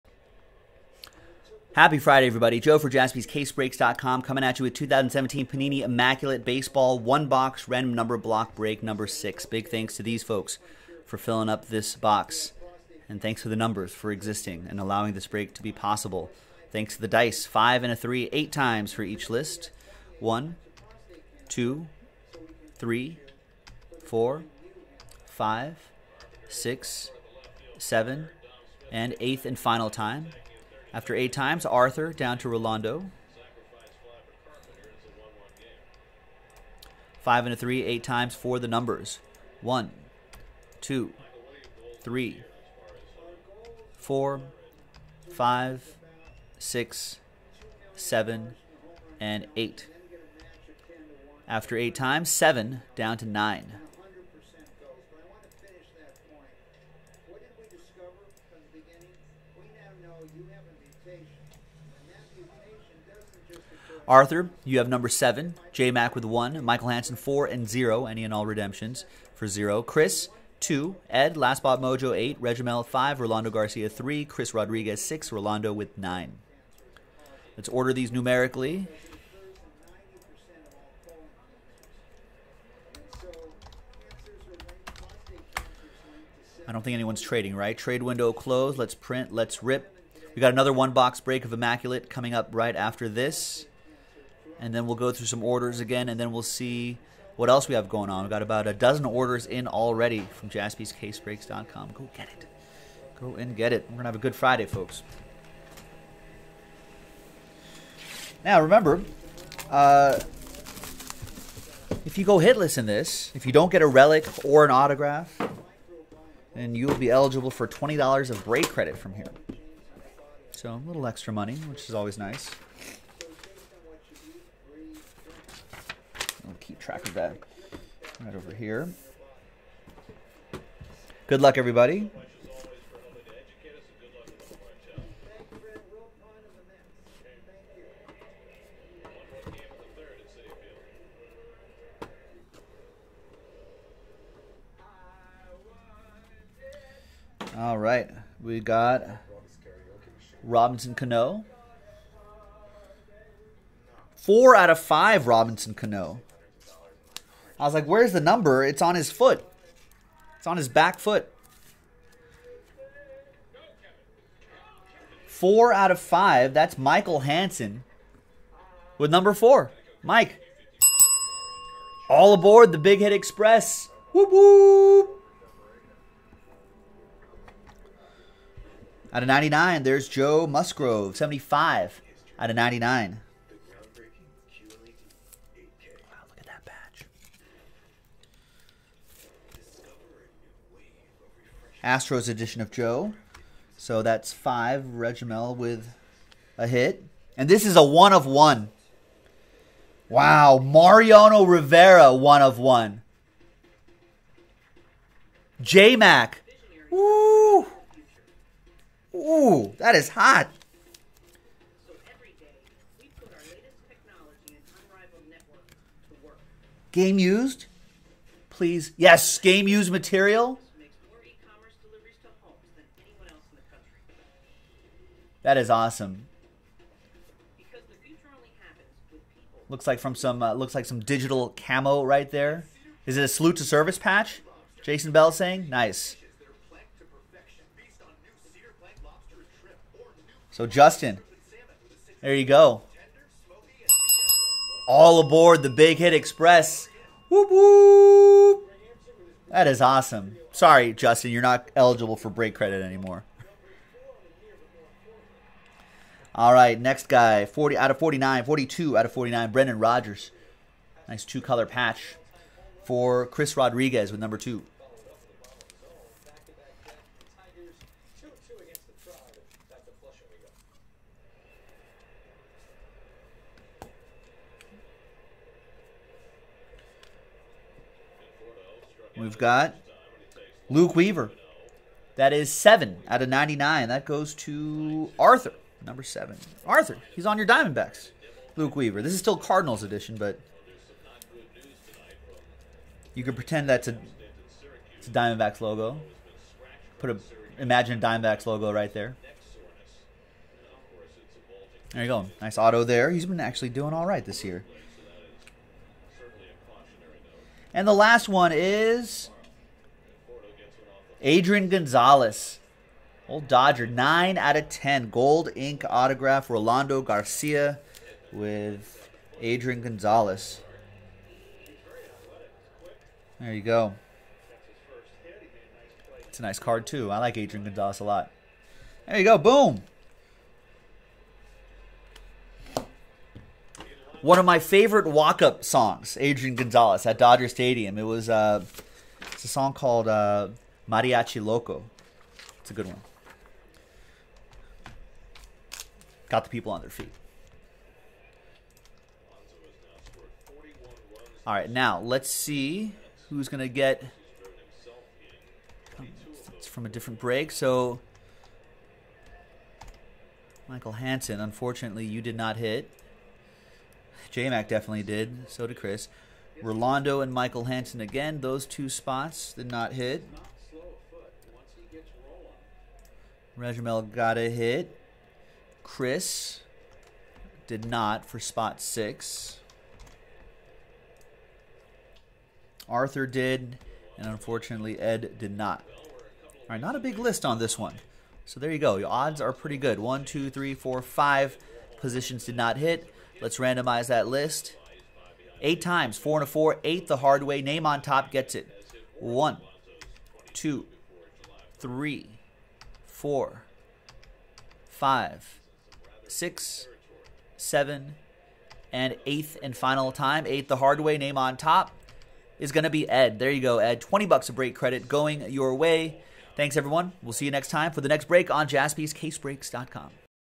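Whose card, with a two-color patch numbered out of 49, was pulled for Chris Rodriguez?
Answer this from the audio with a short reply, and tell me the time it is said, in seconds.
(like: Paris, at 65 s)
Brendan Rodgers, at 259 s.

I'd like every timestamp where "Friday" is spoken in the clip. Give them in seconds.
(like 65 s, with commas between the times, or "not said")
1 s, 104 s.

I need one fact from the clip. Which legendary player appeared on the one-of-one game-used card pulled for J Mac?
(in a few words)
Mariano Rivera.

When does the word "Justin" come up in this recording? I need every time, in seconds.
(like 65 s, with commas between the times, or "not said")
240 s, 250 s.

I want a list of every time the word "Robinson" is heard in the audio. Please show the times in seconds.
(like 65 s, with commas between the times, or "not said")
150 s, 155 s.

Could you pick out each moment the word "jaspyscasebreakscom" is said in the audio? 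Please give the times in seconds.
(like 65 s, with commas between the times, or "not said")
2 s, 100 s, 418 s.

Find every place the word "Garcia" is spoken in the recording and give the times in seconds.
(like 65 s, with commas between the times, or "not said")
73 s, 317 s.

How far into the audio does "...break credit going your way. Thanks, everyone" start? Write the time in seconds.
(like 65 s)
414 s.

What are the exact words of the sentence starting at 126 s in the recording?
I'll keep track of that right over here.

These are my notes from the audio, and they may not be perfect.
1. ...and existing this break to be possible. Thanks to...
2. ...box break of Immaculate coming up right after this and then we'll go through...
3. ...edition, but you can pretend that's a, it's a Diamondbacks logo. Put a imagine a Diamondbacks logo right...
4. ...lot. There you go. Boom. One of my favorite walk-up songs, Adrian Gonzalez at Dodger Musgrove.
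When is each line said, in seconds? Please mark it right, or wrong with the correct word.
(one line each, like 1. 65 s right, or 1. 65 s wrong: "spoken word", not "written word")
1. 14 s wrong: "allowing", not "existing"
2. 90 s right
3. 289 s right
4. 328 s wrong: "Stadium", not "Musgrove".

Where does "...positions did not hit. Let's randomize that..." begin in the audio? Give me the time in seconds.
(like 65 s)
391 s.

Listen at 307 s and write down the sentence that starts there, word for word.
And the last one is Adrian Gonzalez.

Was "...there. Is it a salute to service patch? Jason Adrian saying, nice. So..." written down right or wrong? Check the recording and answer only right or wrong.
wrong.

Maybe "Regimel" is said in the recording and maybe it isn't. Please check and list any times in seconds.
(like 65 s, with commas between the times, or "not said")
72 s, 194 s, 373 s.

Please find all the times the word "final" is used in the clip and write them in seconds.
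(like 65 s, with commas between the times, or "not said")
29 s, 409 s.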